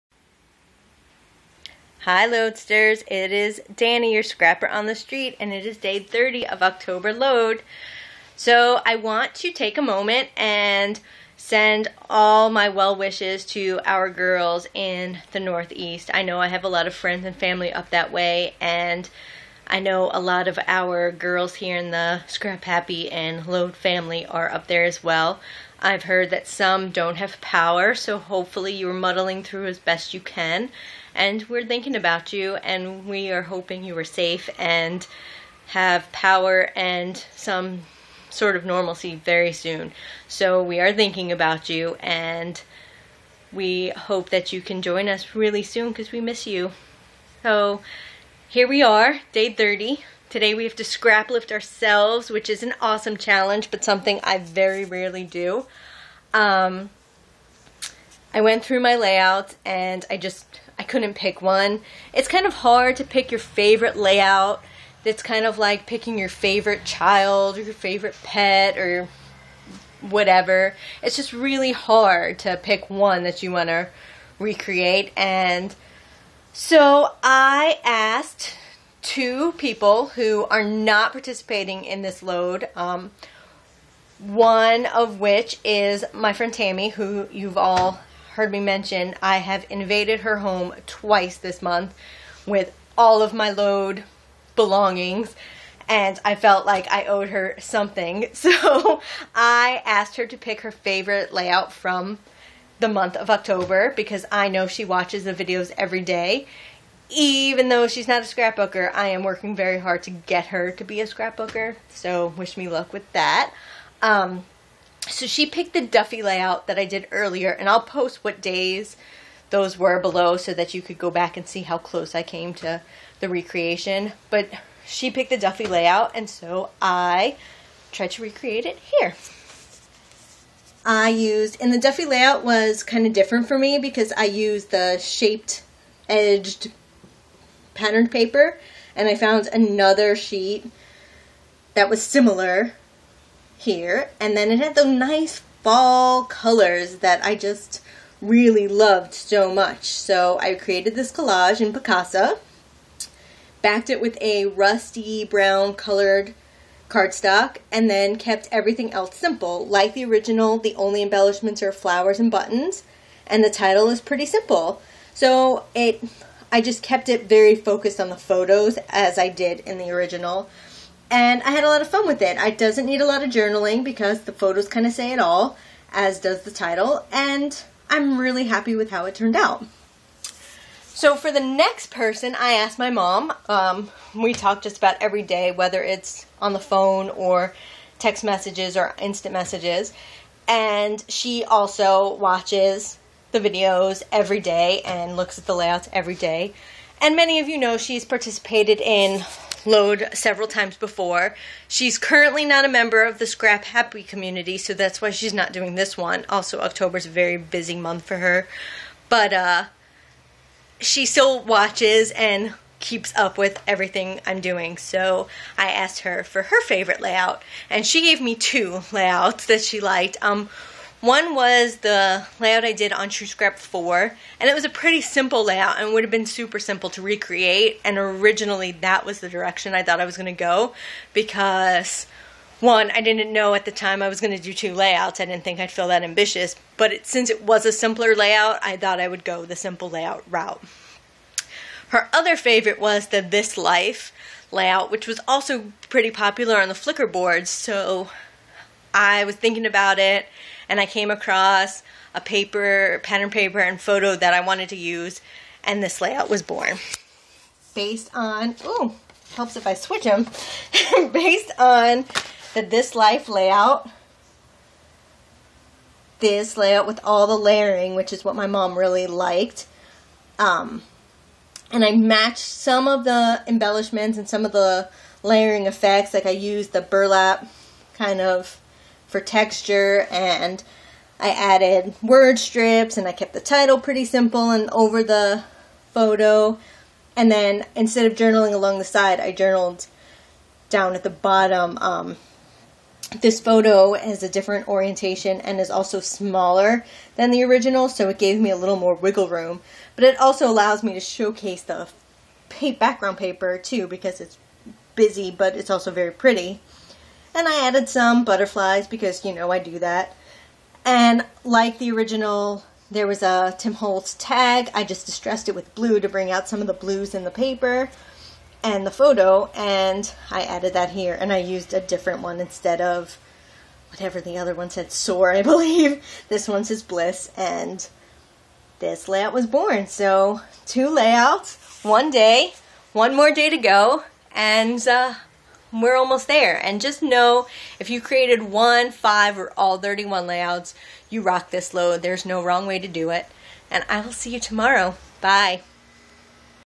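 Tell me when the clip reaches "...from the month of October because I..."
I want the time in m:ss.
1:41.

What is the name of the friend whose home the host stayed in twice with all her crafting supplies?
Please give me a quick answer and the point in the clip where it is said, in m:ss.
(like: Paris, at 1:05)
Tammy, at 1:26.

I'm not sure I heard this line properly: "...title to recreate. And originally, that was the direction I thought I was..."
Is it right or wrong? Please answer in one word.
wrong.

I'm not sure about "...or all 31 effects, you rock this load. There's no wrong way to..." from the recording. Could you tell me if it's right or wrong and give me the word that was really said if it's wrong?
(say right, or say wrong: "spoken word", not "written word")
wrong: "layouts", not "effects".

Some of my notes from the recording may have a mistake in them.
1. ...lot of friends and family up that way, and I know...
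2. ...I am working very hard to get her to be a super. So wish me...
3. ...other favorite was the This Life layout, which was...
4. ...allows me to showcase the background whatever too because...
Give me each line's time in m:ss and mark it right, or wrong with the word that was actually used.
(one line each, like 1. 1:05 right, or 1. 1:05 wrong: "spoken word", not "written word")
1. 0:16 right
2. 1:48 wrong: "scrapbooker", not "super"
3. 4:02 right
4. 5:00 wrong: "paper", not "whatever".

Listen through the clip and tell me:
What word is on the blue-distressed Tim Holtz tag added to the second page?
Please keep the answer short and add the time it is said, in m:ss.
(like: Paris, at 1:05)
bliss, at 5:26.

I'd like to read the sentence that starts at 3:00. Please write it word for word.
So for the next person, I asked my mom.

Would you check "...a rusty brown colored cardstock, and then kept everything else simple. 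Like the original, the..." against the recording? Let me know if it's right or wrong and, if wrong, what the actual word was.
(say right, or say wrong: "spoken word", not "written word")
right.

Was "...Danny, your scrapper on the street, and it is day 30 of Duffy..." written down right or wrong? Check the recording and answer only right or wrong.
wrong.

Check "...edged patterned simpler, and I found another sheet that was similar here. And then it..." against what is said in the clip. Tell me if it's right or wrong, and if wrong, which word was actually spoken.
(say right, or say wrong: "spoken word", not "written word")
wrong: "paper", not "simpler".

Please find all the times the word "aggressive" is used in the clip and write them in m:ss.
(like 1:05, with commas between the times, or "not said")
not said.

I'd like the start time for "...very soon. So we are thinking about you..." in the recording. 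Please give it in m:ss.
0:39.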